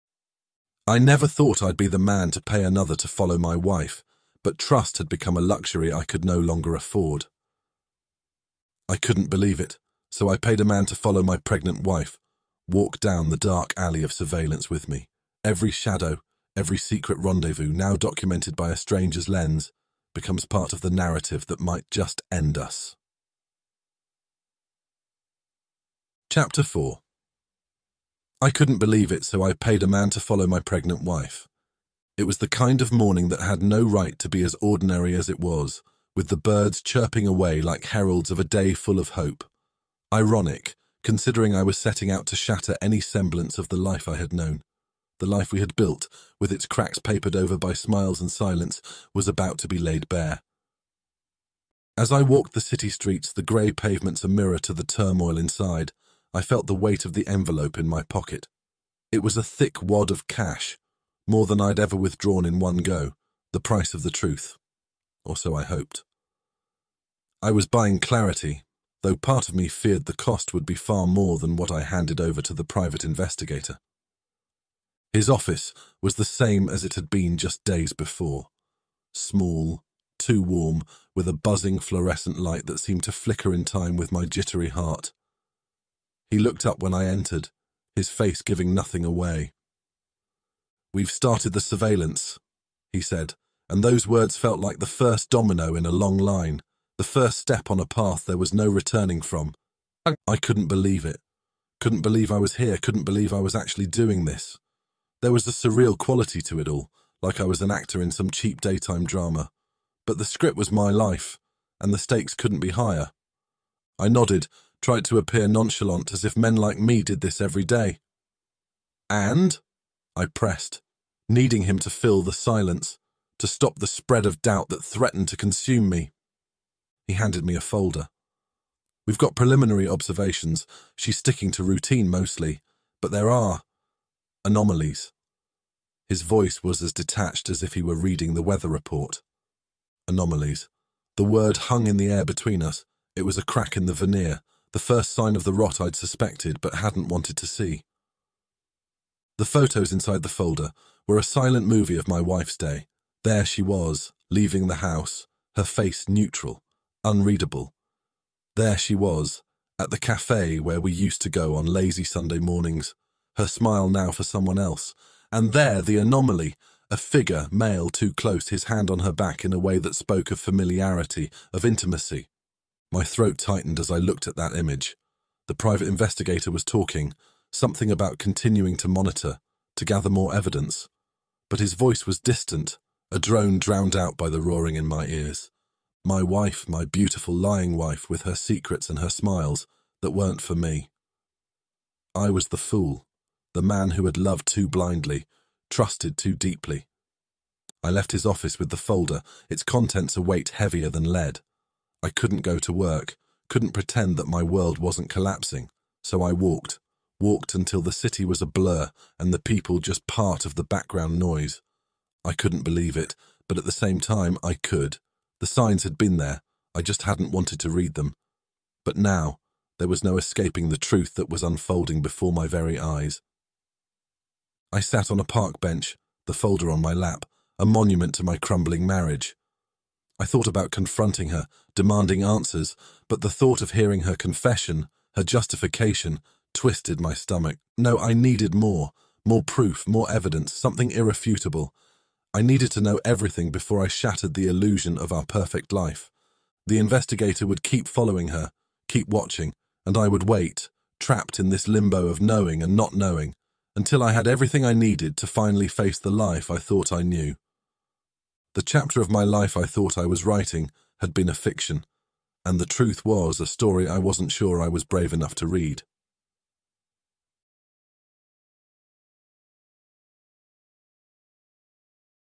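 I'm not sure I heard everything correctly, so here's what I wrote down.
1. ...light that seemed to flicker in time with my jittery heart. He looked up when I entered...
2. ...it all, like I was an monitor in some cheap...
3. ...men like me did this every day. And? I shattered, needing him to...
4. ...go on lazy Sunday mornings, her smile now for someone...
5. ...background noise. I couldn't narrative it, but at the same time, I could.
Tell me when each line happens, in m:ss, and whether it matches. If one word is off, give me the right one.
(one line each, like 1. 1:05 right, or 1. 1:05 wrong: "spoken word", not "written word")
1. 1:22 right
2. 1:46 wrong: "actor", not "monitor"
3. 1:56 wrong: "pressed", not "shattered"
4. 2:41 right
5. 3:30 wrong: "believe", not "narrative".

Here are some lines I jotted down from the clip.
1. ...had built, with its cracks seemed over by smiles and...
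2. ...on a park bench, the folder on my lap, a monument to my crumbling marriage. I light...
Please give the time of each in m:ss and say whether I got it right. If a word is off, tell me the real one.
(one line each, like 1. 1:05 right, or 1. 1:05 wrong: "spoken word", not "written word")
1. 0:45 wrong: "papered", not "seemed"
2. 3:45 wrong: "thought", not "light".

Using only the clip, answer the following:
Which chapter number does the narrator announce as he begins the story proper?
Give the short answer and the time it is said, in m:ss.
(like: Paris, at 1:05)
4, at 0:26.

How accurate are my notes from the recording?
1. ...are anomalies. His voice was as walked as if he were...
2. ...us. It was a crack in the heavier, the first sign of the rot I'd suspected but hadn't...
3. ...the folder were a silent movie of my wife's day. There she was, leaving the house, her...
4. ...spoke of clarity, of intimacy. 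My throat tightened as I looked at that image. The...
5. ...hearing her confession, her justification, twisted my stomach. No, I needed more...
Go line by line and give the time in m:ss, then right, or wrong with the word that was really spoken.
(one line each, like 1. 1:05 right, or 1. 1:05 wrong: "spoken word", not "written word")
1. 2:13 wrong: "detached", not "walked"
2. 2:22 wrong: "veneer", not "heavier"
3. 2:30 right
4. 2:49 wrong: "familiarity", not "clarity"
5. 3:53 right.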